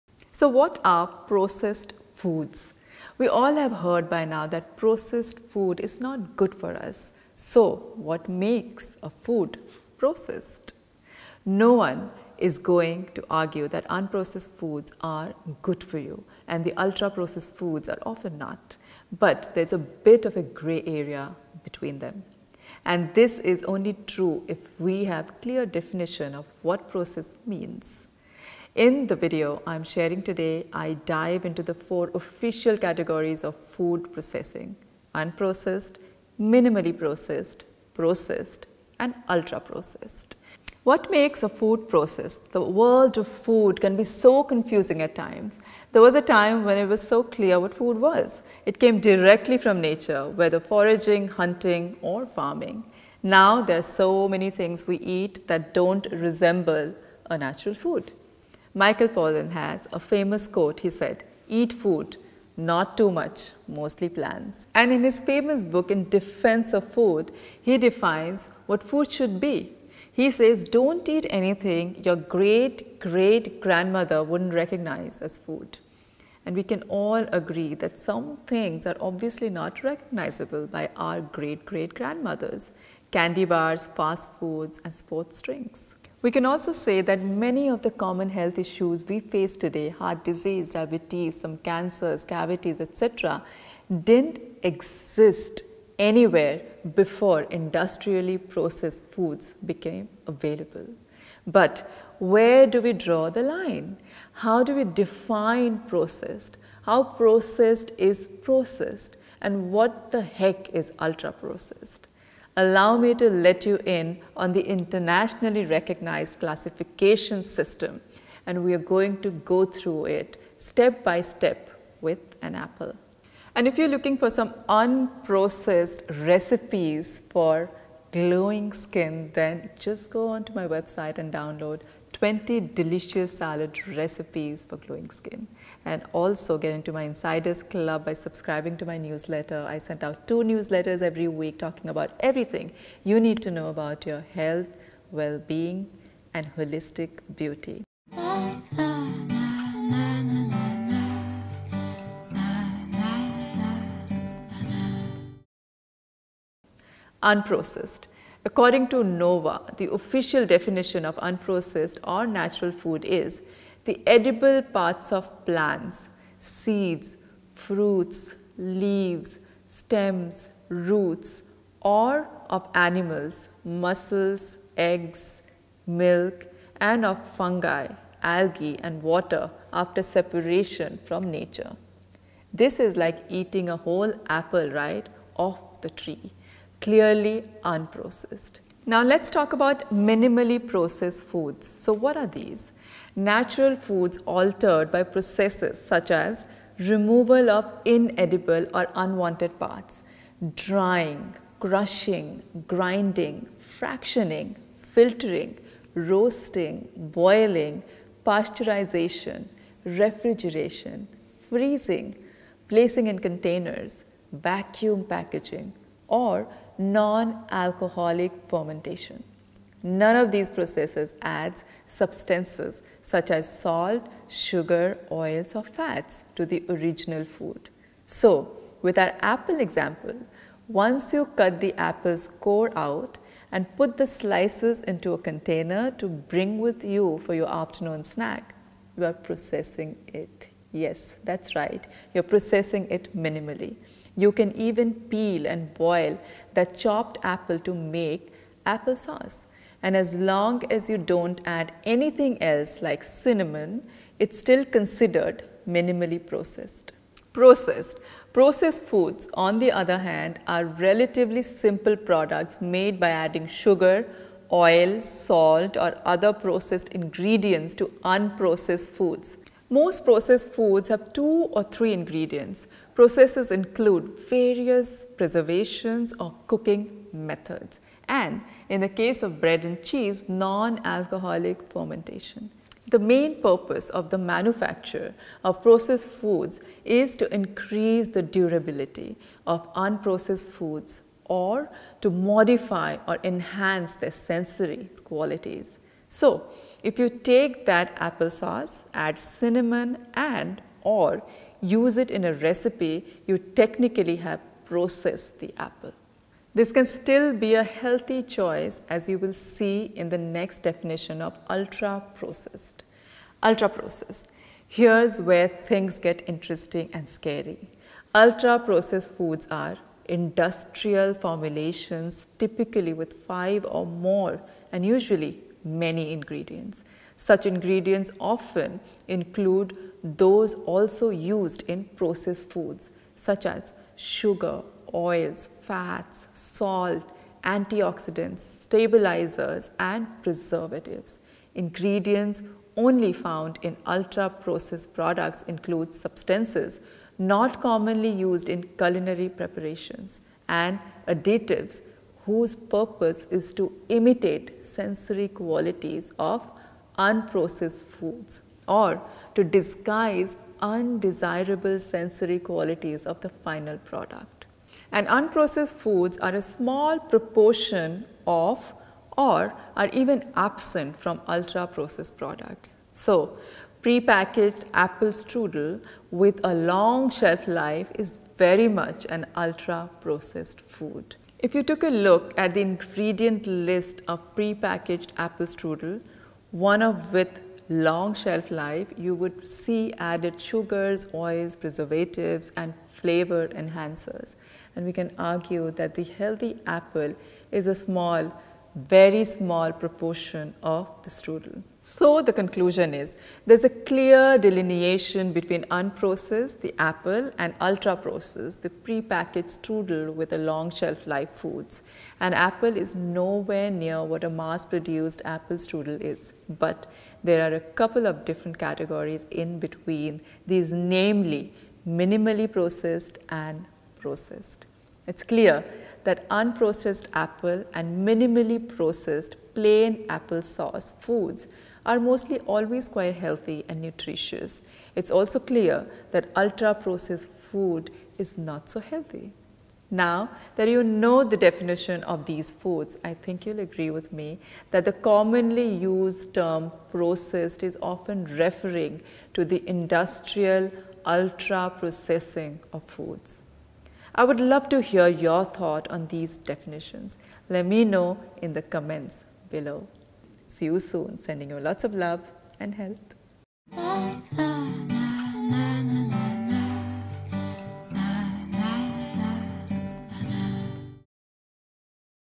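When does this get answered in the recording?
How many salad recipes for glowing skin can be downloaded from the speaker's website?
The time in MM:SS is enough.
02:12.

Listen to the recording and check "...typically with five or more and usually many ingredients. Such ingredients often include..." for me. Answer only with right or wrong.
right.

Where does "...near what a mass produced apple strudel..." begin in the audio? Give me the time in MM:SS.
06:53.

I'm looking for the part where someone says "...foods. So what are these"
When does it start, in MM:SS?
03:11.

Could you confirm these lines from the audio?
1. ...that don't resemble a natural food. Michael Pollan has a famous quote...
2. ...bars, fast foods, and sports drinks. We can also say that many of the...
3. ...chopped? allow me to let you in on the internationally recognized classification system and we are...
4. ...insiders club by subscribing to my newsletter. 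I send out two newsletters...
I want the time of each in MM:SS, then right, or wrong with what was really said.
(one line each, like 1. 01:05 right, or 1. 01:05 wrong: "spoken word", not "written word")
1. 00:55 right
2. 01:23 right
3. 01:51 wrong: "processed", not "chopped"
4. 02:17 right.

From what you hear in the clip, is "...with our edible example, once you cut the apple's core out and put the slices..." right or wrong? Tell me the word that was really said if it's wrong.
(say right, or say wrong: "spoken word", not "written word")
wrong: "apple", not "edible".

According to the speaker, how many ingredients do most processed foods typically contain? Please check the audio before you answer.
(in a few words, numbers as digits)
2 or 3.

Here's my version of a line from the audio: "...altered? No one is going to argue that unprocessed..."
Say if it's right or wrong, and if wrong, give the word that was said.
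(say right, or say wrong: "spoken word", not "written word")
wrong: "processed", not "altered".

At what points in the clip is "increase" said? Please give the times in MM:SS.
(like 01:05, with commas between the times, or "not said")
04:47.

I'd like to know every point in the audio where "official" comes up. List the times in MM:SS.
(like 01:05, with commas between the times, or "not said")
00:32, 02:39.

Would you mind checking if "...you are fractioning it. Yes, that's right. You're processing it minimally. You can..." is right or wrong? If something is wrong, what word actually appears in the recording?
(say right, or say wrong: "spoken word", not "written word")
wrong: "processing", not "fractioning".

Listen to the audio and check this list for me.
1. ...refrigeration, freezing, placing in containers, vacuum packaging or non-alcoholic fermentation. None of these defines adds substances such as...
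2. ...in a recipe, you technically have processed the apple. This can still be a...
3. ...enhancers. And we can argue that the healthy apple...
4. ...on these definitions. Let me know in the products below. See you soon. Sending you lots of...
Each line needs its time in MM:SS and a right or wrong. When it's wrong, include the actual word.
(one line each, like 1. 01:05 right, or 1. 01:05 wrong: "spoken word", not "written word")
1. 03:29 wrong: "processes", not "defines"
2. 05:02 right
3. 06:33 right
4. 07:35 wrong: "comments", not "products".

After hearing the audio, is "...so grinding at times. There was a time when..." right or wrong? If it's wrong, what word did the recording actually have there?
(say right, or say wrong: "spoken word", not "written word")
wrong: "confusing", not "grinding".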